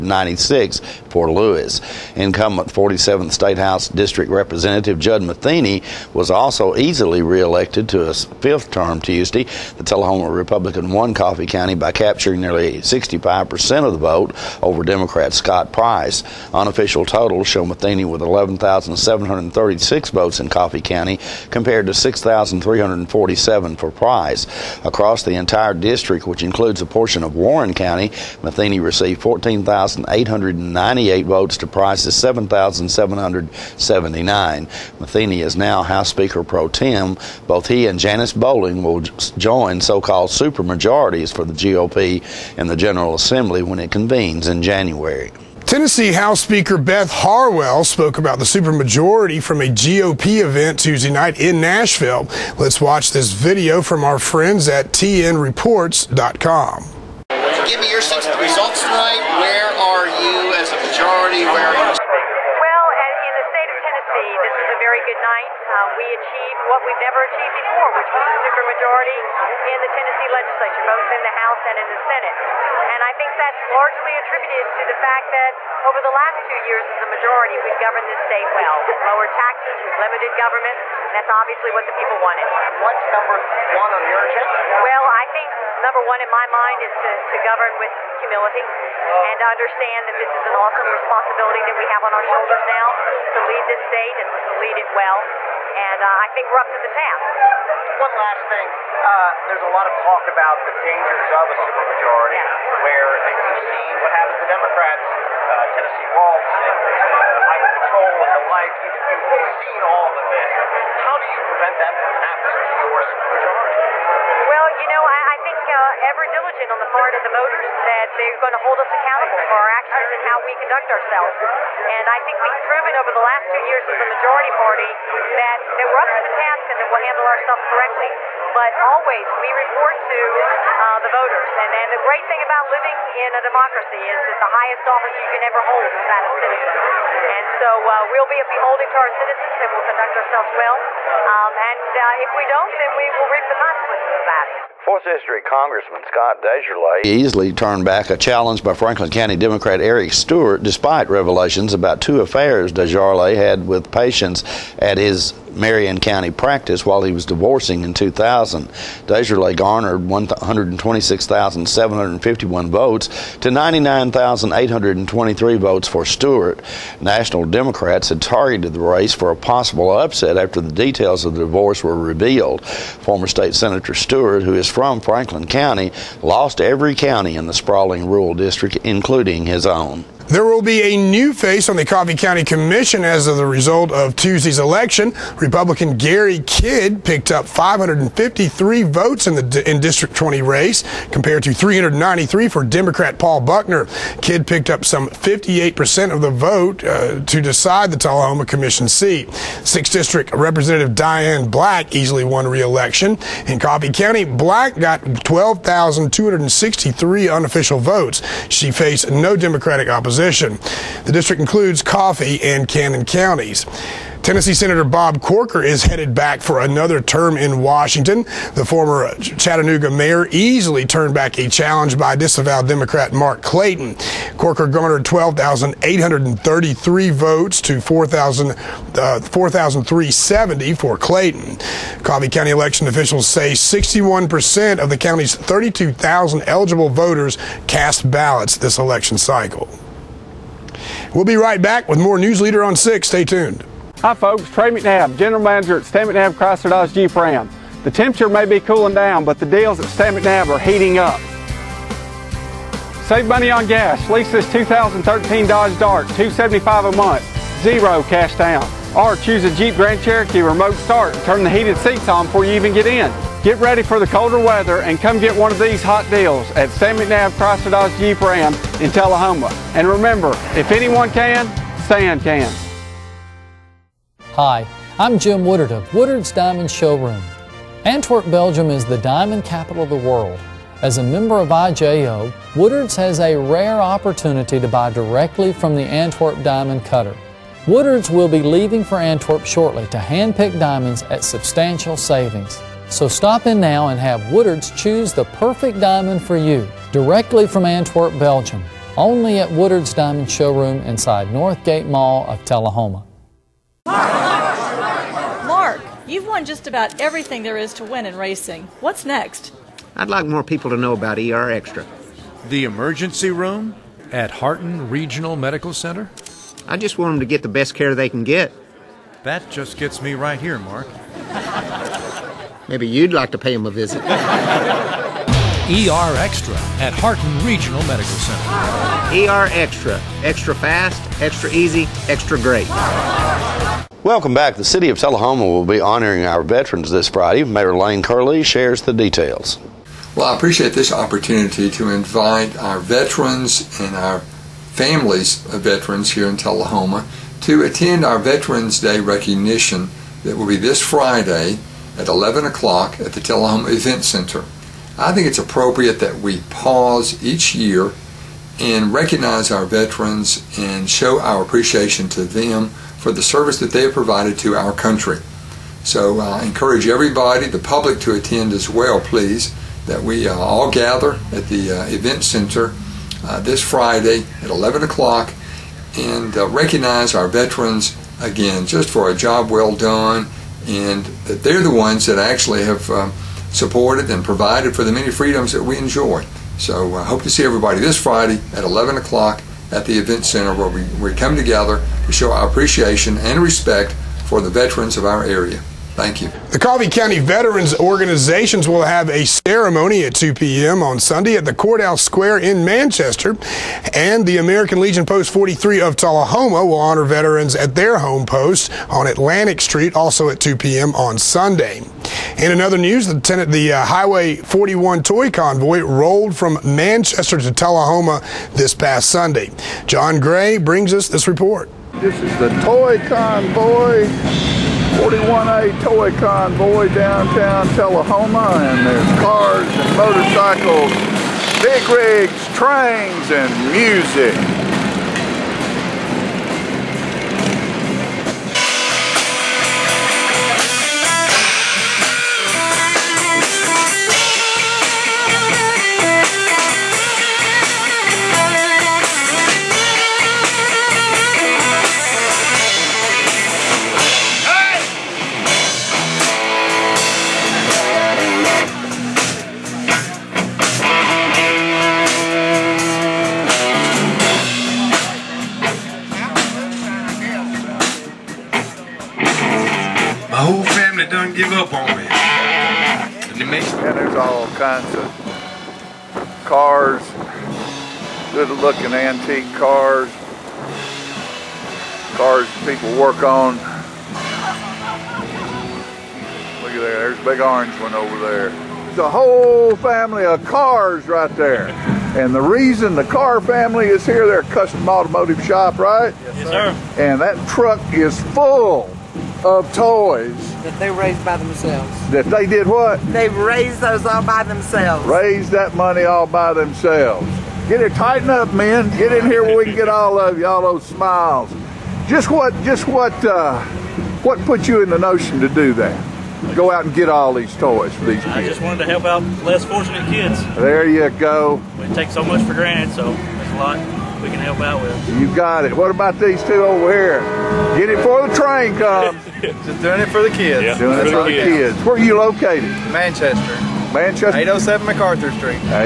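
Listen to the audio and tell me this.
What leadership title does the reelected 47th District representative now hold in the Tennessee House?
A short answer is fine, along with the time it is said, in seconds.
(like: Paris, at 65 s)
House Speaker pro tem, at 35 s.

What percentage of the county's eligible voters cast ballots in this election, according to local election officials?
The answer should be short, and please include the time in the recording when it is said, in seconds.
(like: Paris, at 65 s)
61%, at 233 s.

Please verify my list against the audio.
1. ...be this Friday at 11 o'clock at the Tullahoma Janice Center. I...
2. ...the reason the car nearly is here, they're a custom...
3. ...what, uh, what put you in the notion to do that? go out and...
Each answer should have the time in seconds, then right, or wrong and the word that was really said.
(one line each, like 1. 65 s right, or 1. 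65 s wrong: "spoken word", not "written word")
1. 350 s wrong: "Event", not "Janice"
2. 492 s wrong: "family", not "nearly"
3. 512 s right.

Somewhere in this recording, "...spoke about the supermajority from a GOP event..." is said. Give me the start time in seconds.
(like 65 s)
47 s.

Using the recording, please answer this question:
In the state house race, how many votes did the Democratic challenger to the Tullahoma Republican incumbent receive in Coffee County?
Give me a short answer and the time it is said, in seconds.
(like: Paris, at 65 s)
6,347, at 21 s.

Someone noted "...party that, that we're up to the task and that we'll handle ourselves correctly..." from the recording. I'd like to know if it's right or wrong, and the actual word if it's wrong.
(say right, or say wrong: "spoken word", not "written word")
right.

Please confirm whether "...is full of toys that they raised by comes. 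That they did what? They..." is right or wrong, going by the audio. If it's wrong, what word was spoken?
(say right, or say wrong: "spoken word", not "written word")
wrong: "themselves", not "comes".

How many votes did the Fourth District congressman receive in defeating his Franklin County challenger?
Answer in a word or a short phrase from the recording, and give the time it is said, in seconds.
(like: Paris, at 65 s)
126,751, at 160 s.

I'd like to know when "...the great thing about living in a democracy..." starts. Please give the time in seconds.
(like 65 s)
131 s.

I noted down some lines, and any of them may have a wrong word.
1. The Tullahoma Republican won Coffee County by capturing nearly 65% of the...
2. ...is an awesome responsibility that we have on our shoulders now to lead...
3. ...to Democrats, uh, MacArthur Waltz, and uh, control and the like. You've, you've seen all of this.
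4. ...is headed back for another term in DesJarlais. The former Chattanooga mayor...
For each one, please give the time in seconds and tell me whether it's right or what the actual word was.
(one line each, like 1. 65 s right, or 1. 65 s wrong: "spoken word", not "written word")
1. 9 s right
2. 90 s right
3. 104 s wrong: "Tennessee", not "MacArthur"
4. 215 s wrong: "Washington", not "DesJarlais".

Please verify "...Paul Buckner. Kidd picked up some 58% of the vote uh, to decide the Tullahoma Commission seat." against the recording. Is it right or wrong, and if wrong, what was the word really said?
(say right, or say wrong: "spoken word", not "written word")
right.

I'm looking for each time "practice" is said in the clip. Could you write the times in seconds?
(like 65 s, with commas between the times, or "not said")
156 s.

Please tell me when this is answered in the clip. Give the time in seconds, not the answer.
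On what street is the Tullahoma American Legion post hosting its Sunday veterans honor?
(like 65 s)
409 s.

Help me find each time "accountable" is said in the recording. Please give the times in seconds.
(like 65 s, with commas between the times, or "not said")
118 s.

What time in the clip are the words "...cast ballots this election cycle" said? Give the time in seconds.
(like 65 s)
237 s.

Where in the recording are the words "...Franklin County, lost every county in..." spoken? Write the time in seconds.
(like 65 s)
174 s.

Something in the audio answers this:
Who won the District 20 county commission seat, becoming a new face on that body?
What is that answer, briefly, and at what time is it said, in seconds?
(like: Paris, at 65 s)
Gary Kidd, at 185 s.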